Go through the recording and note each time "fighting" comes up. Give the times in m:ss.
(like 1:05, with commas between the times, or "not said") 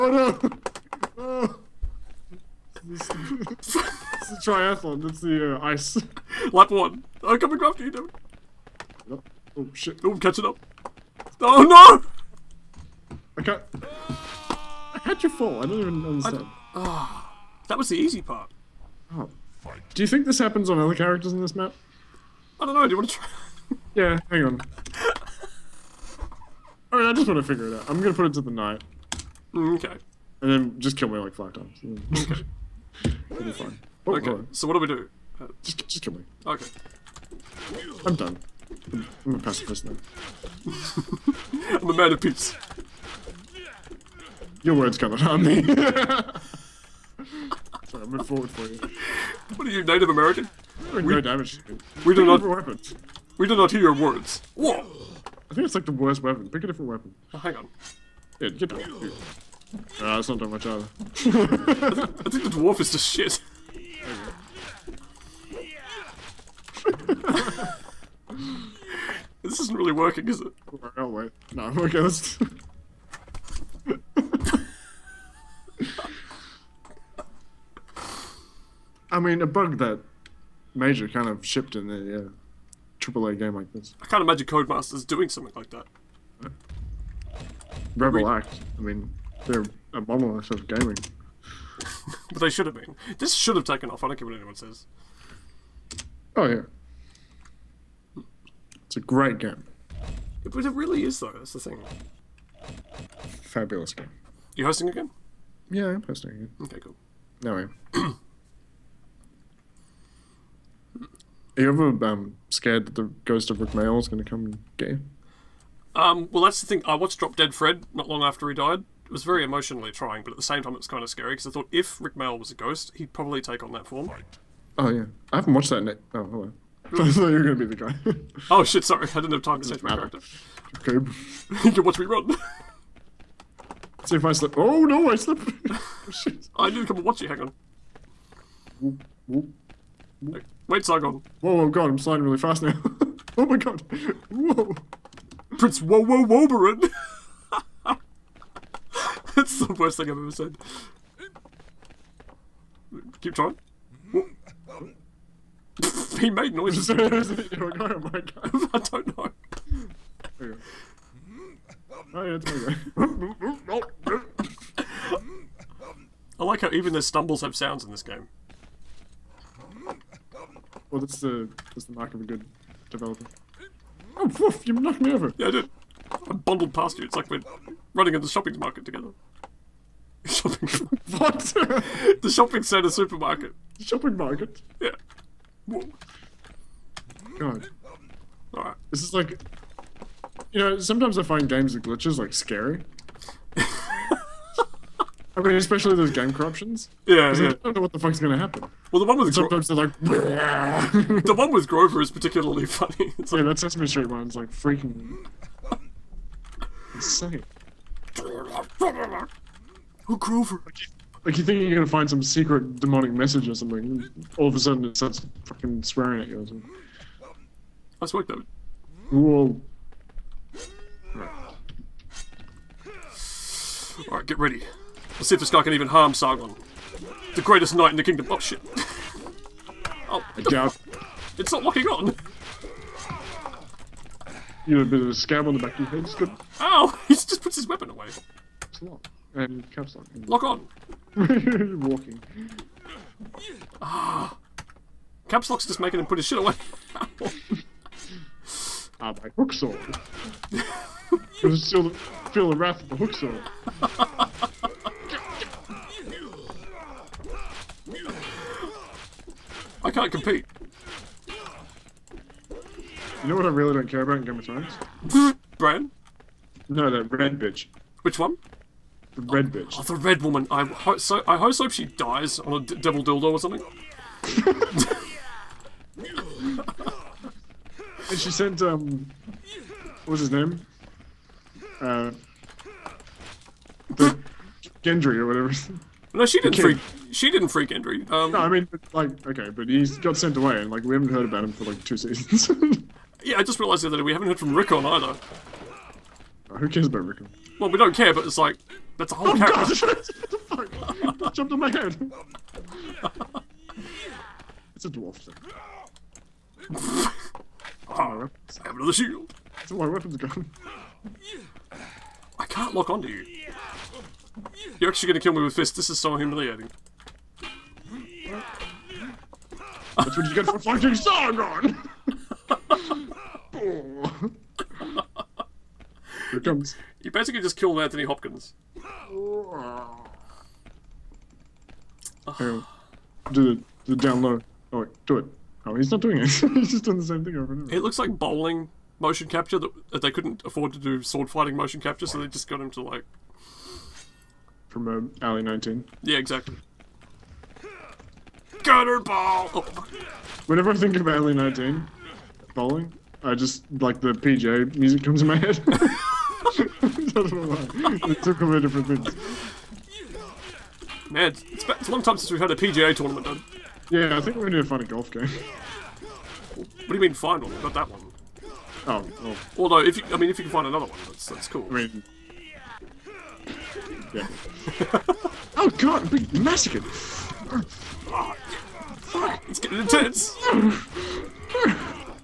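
5:20, 5:41.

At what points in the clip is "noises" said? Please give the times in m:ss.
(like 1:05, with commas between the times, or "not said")
2:36.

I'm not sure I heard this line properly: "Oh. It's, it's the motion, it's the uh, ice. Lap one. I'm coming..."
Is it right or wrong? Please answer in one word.
wrong.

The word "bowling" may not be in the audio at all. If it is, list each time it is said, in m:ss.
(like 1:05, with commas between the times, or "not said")
5:38, 5:52.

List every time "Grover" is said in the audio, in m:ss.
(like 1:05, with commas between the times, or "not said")
3:21, 3:30.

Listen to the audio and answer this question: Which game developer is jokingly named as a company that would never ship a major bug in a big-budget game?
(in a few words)
Codemasters.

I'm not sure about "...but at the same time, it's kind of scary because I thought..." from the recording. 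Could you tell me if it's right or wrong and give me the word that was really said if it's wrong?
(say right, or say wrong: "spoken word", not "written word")
right.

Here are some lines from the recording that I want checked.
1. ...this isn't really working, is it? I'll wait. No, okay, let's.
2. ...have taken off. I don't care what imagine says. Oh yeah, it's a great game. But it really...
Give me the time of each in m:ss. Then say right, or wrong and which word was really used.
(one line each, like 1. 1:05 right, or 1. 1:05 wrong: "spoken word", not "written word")
1. 1:09 right
2. 1:33 wrong: "anyone", not "imagine".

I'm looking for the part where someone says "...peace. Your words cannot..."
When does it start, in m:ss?
0:42.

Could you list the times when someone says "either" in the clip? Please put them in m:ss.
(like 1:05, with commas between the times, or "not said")
1:00, 4:54.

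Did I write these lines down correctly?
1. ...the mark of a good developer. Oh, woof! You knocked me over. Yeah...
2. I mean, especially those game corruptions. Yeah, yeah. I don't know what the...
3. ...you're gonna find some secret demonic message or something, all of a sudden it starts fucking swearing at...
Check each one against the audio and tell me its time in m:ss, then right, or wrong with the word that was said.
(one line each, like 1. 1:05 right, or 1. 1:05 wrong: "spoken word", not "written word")
1. 2:51 right
2. 3:15 right
3. 3:31 right.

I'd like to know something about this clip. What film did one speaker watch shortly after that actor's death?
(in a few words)
Drop Dead Fred.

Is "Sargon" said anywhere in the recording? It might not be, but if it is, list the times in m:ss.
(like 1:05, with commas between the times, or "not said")
2:20, 3:46, 5:20.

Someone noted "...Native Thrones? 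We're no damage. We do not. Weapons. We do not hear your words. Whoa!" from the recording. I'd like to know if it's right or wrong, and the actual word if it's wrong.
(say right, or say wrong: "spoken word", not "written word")
wrong: "American", not "Thrones".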